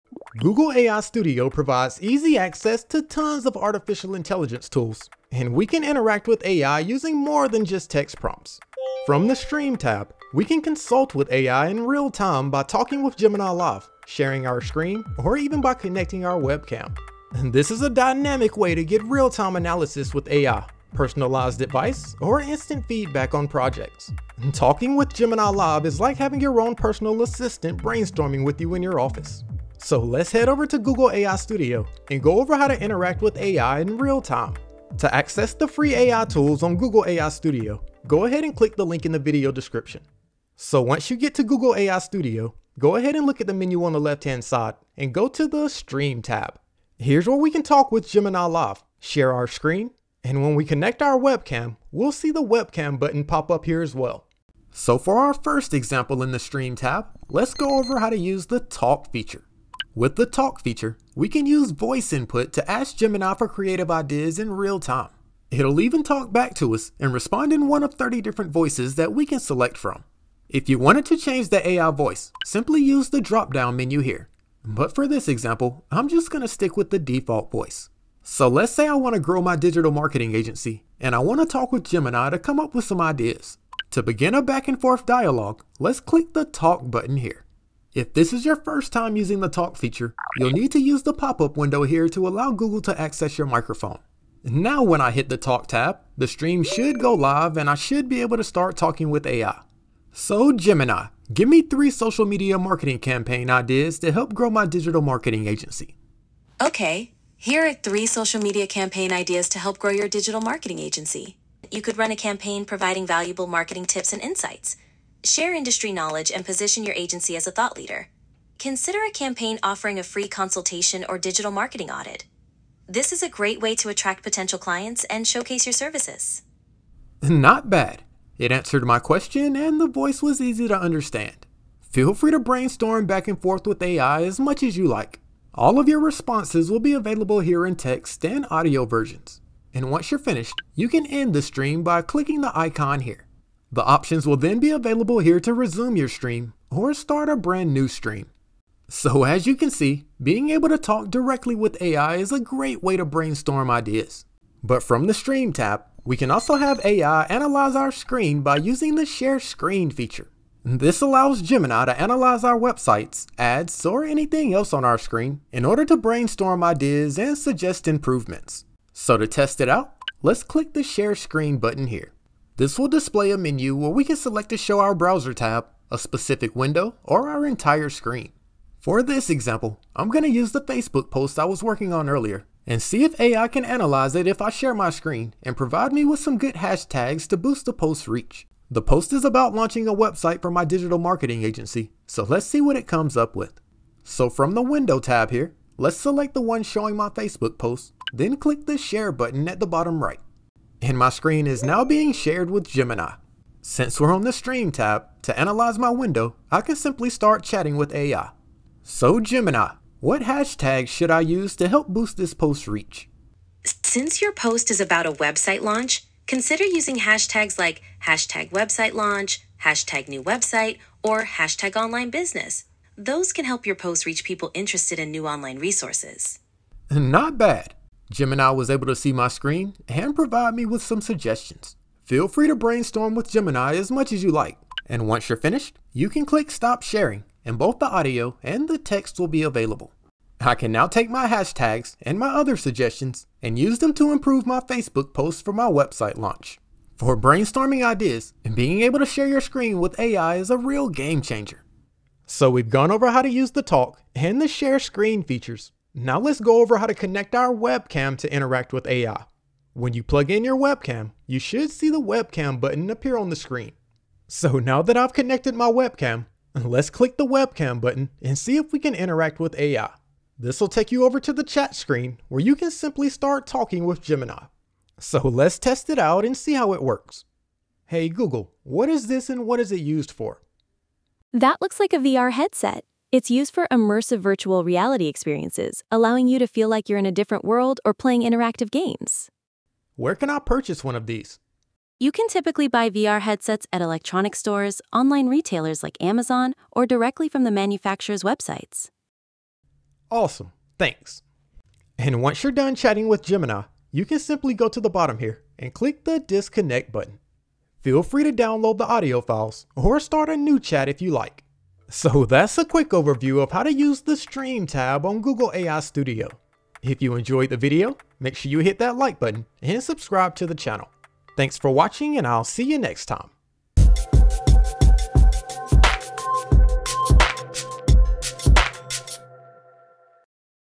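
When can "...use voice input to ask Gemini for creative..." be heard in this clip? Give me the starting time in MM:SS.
01:01.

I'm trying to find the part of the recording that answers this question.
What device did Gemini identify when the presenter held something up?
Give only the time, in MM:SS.
04:41.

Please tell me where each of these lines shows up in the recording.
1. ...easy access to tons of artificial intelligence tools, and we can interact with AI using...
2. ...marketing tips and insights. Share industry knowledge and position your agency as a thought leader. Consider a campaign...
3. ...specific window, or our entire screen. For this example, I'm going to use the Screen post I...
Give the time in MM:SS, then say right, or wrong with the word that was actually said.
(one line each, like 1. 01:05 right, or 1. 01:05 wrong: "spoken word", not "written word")
1. 00:02 right
2. 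01:53 right
3. 02:55 wrong: "Facebook", not "Screen".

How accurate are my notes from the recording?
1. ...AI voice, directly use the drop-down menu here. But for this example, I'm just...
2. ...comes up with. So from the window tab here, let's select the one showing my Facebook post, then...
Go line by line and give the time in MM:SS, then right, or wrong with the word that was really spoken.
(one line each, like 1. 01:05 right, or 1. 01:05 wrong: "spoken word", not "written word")
1. 01:11 wrong: "simply", not "directly"
2. 03:12 right.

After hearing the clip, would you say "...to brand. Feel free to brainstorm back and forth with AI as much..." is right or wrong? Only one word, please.
wrong.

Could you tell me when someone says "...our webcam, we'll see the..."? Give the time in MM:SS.
00:51.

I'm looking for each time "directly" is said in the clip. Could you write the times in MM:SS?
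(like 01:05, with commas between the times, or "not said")
02:31, 04:56.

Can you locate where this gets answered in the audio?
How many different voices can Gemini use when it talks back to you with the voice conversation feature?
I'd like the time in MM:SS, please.
01:07.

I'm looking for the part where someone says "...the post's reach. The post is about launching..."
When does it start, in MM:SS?
03:07.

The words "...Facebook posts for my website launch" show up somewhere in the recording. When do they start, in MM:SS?
04:04.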